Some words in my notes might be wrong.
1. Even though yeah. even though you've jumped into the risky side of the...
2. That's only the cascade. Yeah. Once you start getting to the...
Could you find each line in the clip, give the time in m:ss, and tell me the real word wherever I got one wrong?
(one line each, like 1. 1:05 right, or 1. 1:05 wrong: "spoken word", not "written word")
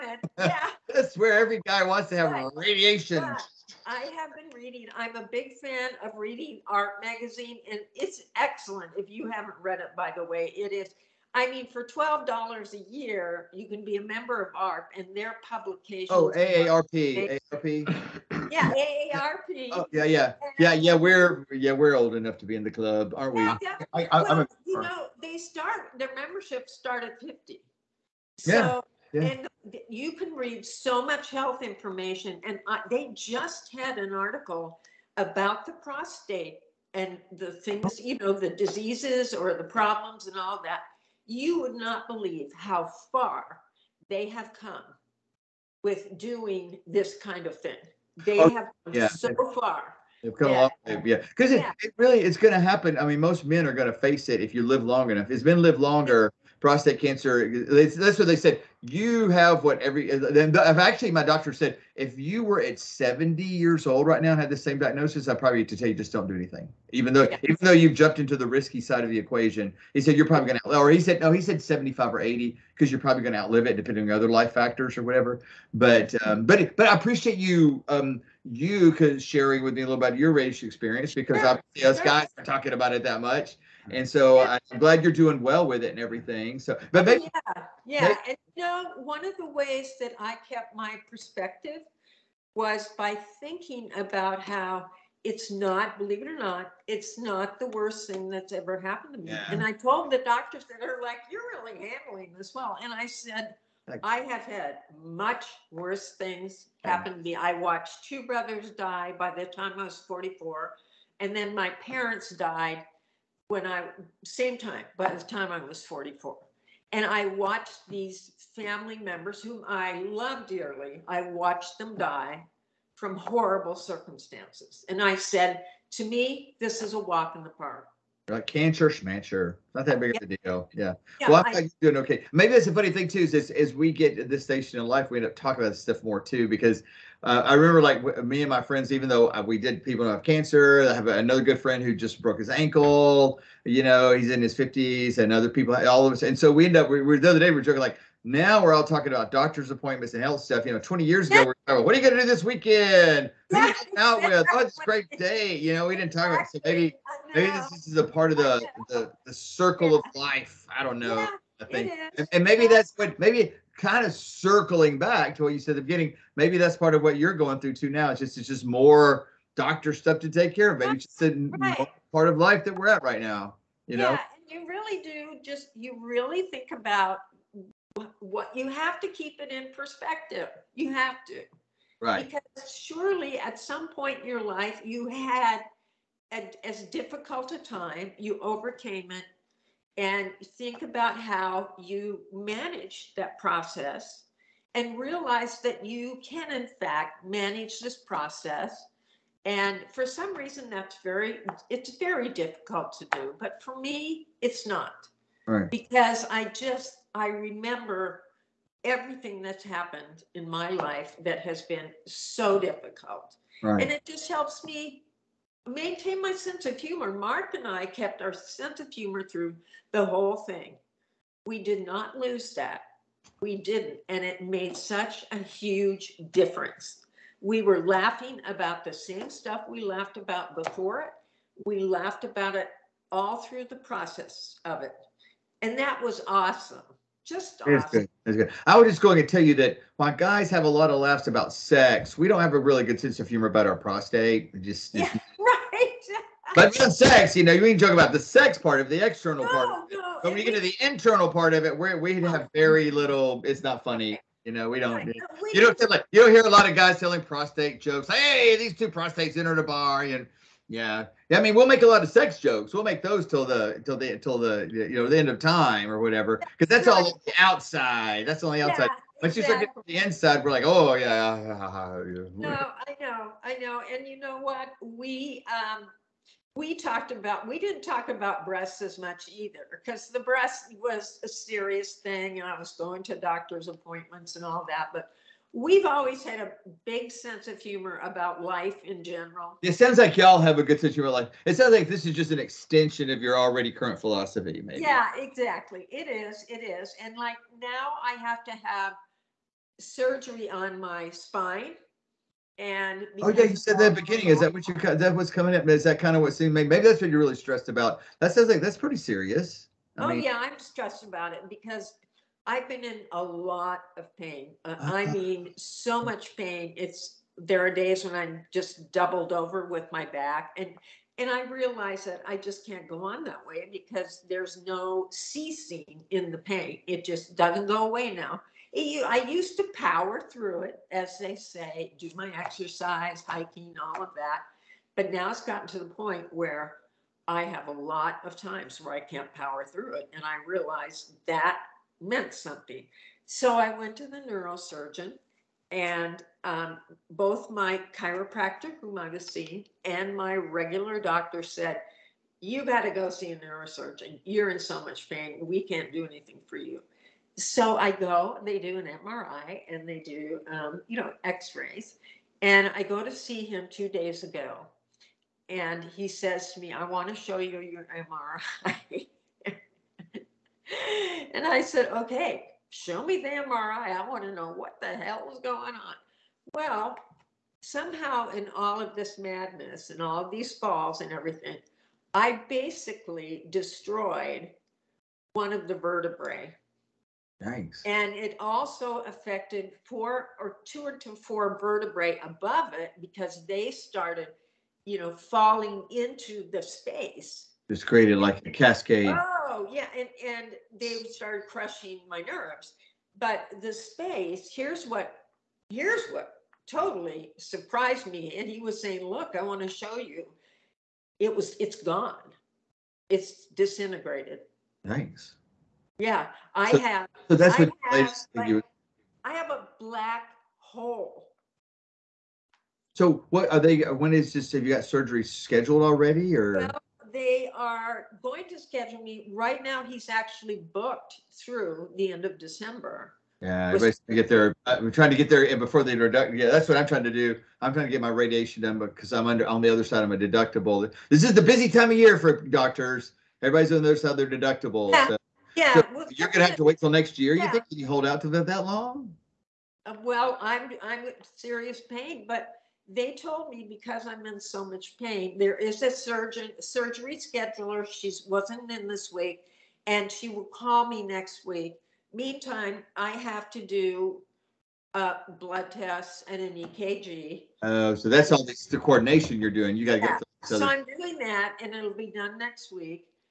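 1. 1:06 right
2. 4:28 wrong: "outside", not "cascade".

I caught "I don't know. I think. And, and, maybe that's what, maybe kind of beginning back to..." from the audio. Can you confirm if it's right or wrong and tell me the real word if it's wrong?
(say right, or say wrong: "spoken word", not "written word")
wrong: "circling", not "beginning".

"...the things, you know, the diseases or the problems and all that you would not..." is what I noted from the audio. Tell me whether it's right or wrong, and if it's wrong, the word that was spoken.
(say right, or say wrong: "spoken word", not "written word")
right.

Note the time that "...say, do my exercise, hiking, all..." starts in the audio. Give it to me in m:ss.
5:31.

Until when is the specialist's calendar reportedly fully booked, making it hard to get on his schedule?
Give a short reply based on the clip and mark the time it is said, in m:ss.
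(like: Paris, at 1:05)
End of December, at 7:12.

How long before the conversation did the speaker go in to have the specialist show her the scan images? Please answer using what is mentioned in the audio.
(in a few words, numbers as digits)
Two days ago.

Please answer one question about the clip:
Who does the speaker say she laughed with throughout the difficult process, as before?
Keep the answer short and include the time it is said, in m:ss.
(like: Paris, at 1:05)
Mark, at 3:37.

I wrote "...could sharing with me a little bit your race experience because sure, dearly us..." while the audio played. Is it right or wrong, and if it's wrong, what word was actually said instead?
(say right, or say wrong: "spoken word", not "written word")
wrong: "obviously", not "dearly".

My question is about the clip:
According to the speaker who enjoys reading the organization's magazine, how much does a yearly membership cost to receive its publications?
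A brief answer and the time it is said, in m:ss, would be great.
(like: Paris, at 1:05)
$12, at 0:11.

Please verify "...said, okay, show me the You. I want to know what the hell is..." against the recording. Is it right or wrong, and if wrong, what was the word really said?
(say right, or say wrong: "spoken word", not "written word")
wrong: "MRI", not "You".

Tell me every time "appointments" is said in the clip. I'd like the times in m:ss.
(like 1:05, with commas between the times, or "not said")
2:29, 4:43.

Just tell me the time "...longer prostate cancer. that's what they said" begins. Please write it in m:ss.
0:55.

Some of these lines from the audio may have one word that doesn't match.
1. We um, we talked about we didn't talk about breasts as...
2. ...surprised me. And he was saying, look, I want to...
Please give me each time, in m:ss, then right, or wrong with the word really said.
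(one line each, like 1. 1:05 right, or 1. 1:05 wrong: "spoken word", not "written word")
1. 4:34 right
2. 6:47 right.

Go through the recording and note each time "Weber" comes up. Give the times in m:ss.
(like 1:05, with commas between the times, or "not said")
not said.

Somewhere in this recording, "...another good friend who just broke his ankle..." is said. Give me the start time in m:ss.
2:21.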